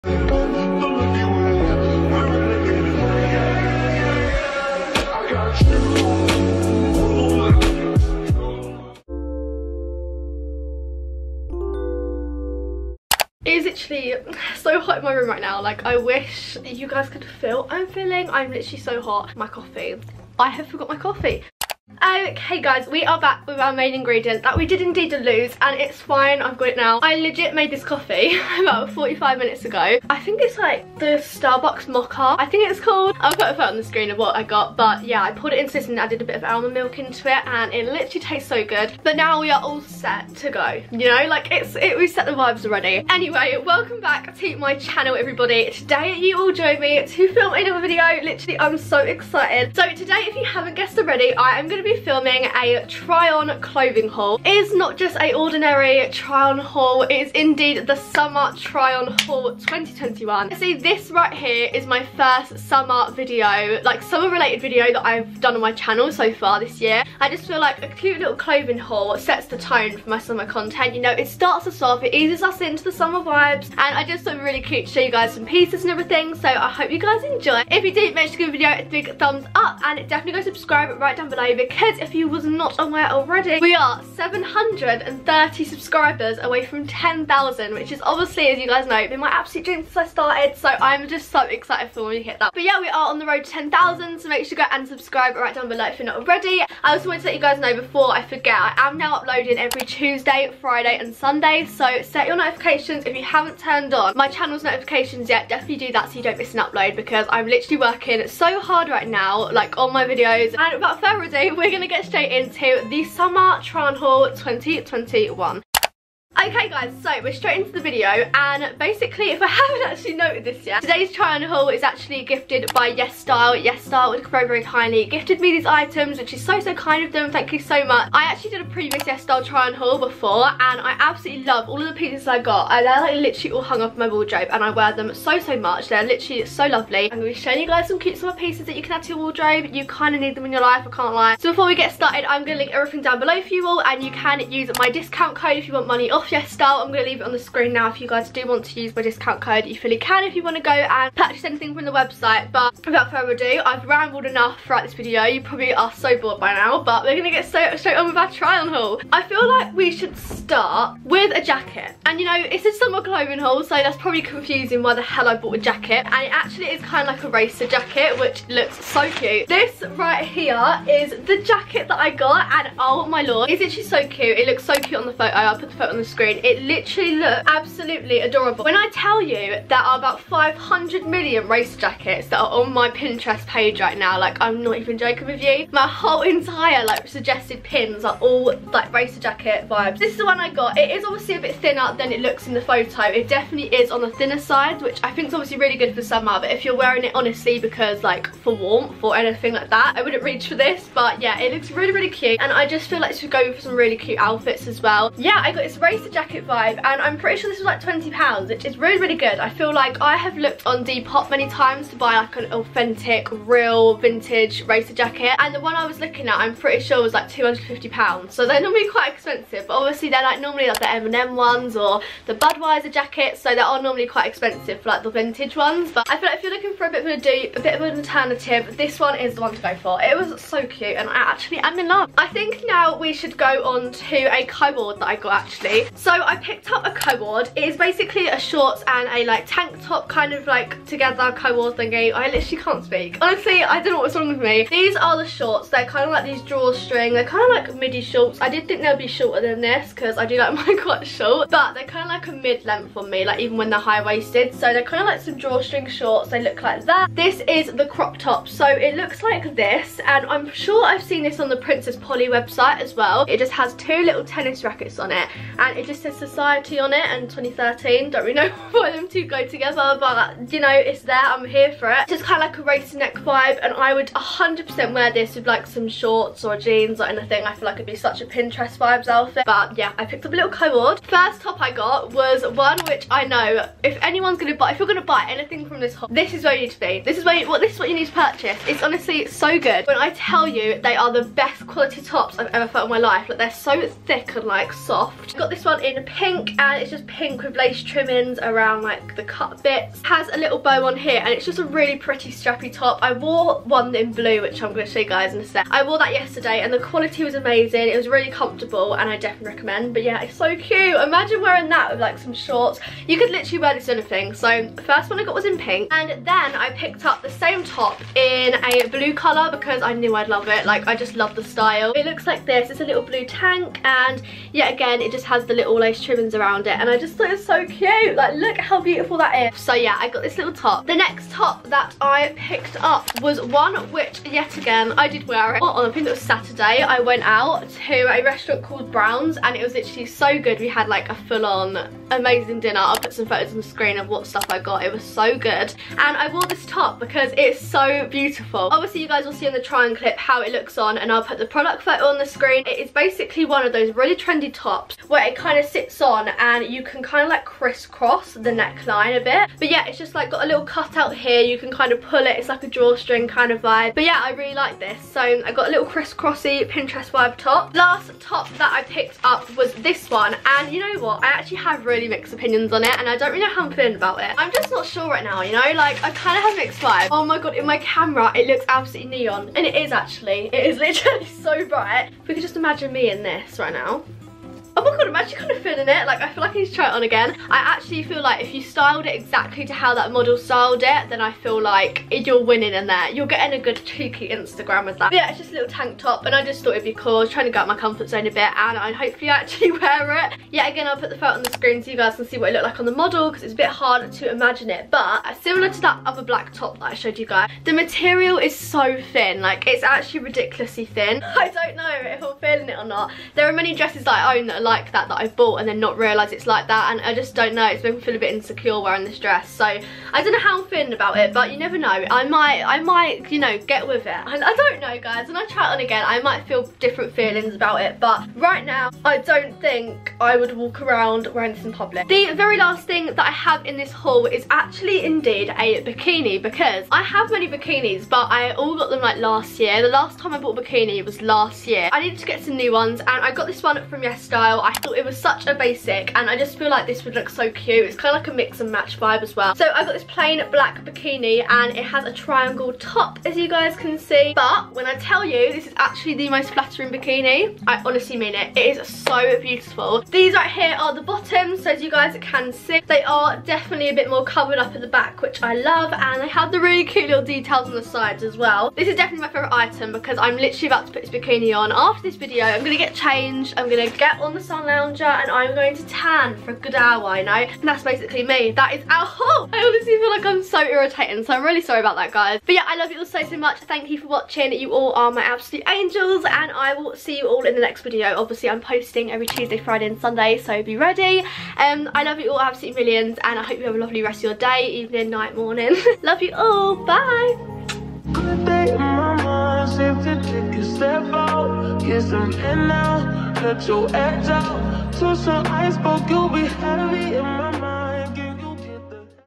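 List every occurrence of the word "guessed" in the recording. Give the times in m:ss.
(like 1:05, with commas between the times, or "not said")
0:50.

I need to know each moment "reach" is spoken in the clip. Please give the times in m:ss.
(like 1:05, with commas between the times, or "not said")
3:20.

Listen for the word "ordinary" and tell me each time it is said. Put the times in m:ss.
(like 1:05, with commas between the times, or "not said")
0:55.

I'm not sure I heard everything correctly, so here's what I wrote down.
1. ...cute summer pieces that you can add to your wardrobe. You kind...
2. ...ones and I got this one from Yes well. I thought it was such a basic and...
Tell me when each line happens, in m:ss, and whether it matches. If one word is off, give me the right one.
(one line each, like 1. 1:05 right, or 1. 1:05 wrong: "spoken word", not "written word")
1. 2:17 right
2. 7:22 right.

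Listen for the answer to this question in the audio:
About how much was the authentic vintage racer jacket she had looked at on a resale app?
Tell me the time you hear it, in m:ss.
3:37.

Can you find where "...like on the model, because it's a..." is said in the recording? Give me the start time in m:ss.
6:42.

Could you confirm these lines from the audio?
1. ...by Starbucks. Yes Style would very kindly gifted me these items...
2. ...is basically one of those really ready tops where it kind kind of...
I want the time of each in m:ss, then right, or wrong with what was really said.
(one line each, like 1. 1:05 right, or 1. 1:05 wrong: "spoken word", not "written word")
1. 2:02 wrong: "YesStyle", not "Starbucks"
2. 5:52 wrong: "trendy", not "ready".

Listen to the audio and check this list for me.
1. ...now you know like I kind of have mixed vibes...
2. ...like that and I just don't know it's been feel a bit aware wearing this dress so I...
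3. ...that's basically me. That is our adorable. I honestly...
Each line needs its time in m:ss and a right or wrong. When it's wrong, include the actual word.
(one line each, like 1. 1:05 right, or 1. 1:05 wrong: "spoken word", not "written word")
1. 6:15 right
2. 6:56 wrong: "insecure", not "aware"
3. 7:57 wrong: "whole", not "adorable".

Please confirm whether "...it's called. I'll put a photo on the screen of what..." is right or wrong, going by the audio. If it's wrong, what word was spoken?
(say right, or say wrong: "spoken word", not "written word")
right.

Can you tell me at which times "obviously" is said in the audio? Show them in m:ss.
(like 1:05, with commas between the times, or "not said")
1:28, 3:11, 3:15, 3:39, 5:48, 8:08.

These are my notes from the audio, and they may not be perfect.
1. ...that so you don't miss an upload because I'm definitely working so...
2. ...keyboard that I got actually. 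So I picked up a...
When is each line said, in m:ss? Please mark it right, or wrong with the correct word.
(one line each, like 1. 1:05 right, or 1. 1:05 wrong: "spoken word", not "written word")
1. 1:45 wrong: "literally", not "definitely"
2. 3:54 right.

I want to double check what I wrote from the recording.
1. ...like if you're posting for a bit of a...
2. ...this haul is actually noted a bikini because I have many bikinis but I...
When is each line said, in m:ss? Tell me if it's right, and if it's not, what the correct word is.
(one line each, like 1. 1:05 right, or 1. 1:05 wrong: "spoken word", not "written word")
1. 3:46 wrong: "looking", not "posting"
2. 7:13 wrong: "indeed", not "noted".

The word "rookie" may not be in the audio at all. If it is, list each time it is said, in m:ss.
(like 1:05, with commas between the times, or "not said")
not said.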